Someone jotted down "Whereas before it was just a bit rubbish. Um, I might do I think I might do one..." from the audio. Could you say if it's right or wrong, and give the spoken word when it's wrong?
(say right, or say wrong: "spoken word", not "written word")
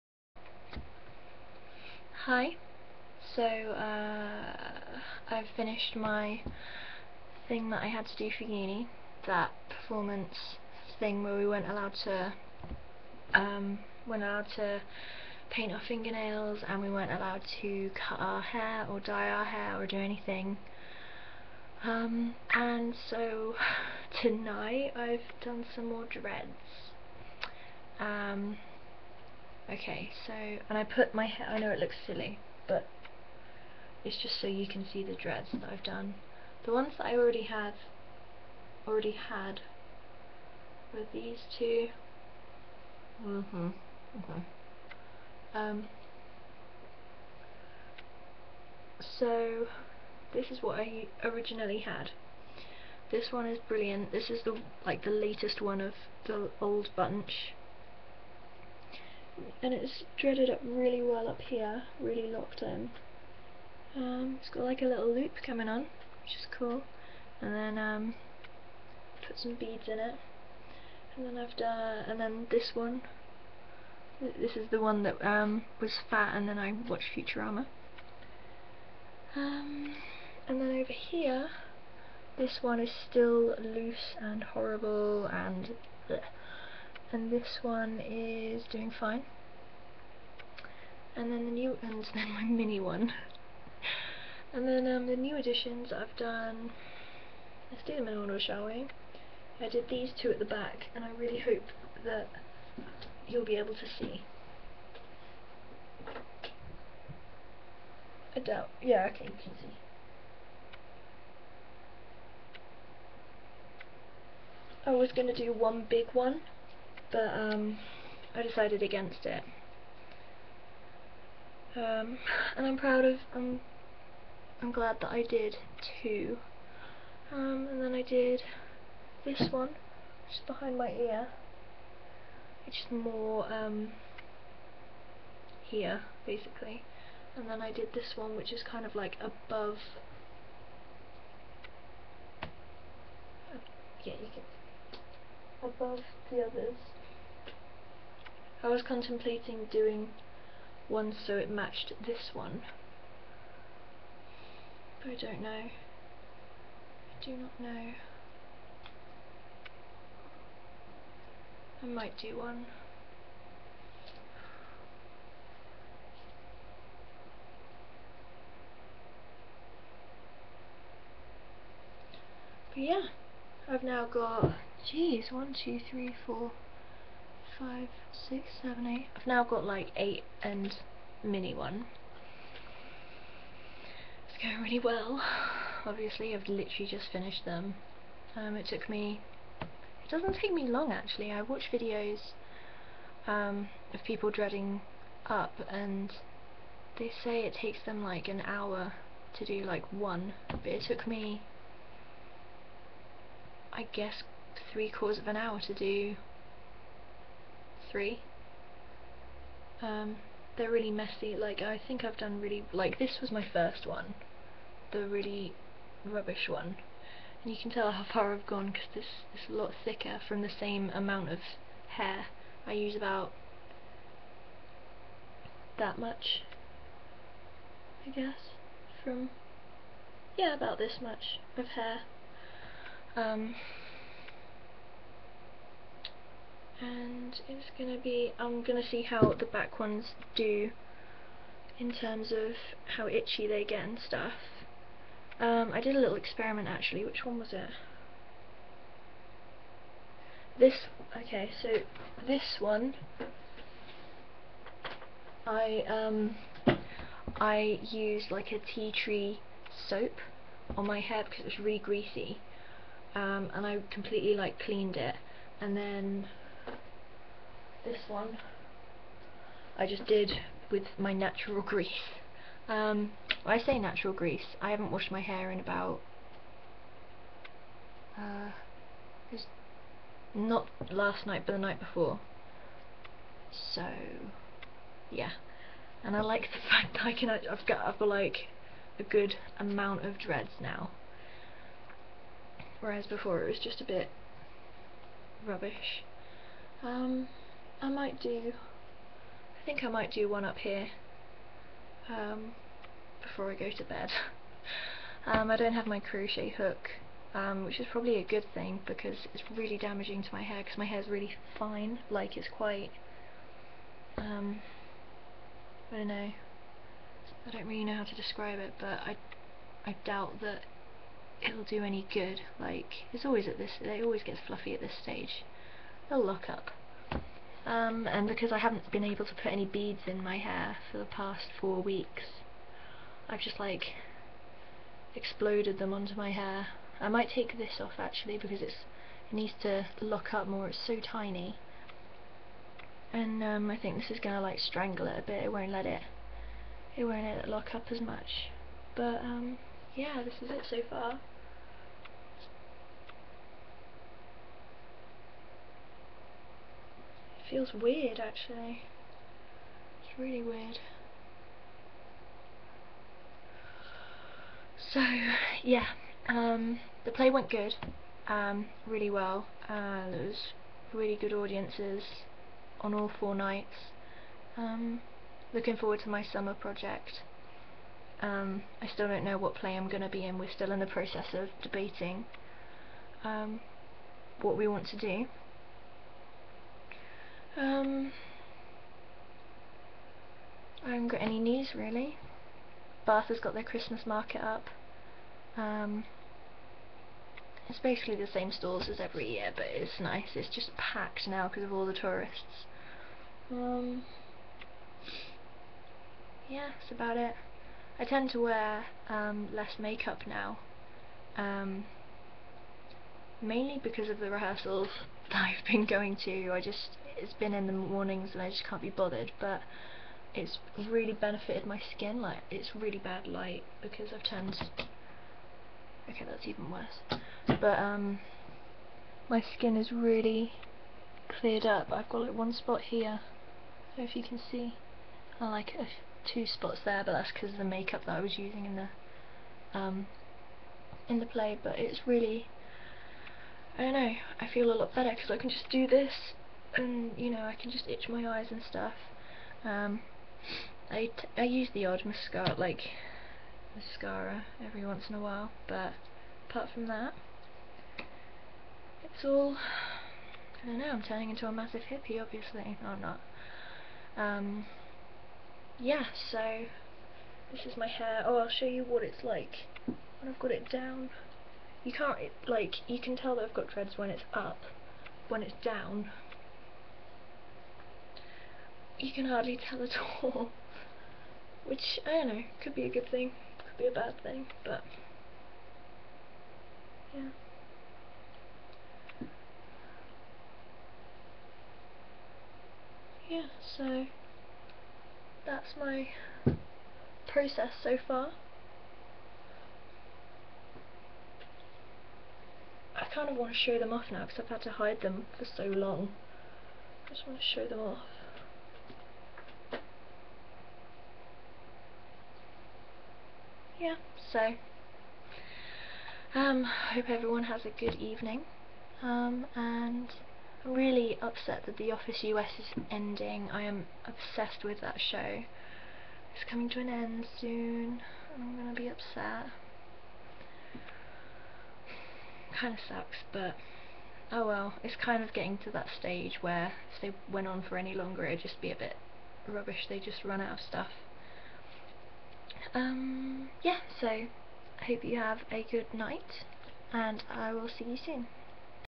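right.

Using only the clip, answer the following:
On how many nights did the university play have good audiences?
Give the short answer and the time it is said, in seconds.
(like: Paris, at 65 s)
4, at 373 s.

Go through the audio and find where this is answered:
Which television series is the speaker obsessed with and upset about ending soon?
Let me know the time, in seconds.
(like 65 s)
521 s.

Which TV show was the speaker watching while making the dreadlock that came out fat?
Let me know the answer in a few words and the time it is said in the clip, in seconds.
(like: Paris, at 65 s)
Futurama, at 77 s.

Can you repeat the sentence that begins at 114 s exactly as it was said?
I was going to do one big one but um, I decided against it.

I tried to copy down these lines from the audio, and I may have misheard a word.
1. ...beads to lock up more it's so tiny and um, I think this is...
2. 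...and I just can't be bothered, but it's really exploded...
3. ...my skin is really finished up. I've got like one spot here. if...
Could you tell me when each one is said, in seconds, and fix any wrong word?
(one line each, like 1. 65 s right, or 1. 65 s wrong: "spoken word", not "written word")
1. 339 s wrong: "needs", not "beads"
2. 418 s wrong: "benefited", not "exploded"
3. 429 s wrong: "cleared", not "finished".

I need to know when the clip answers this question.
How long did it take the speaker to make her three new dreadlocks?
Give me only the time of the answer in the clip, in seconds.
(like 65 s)
204 s.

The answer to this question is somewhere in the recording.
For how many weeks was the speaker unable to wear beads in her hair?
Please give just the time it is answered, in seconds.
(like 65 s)
331 s.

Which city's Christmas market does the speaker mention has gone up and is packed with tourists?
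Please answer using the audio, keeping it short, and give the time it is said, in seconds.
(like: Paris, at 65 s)
Bath, at 393 s.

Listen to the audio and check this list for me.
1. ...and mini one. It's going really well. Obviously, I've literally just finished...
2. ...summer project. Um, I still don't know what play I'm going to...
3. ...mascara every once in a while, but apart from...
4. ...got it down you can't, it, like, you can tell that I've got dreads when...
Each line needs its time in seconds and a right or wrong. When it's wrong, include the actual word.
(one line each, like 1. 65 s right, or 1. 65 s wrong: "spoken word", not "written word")
1. 180 s right
2. 376 s right
3. 453 s right
4. 470 s right.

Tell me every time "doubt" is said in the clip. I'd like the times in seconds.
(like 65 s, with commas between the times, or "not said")
108 s, 320 s.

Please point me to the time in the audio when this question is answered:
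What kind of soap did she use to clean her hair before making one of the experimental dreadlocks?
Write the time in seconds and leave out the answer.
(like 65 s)
258 s.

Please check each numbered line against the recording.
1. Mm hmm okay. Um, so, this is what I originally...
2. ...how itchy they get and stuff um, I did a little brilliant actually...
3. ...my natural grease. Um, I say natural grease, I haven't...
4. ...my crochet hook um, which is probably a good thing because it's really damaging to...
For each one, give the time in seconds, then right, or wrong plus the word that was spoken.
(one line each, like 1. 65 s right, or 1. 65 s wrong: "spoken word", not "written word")
1. 43 s right
2. 242 s wrong: "experiment", not "brilliant"
3. 270 s right
4. 305 s right.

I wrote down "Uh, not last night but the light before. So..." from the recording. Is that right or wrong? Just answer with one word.
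wrong.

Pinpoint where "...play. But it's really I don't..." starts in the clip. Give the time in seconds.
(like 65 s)
441 s.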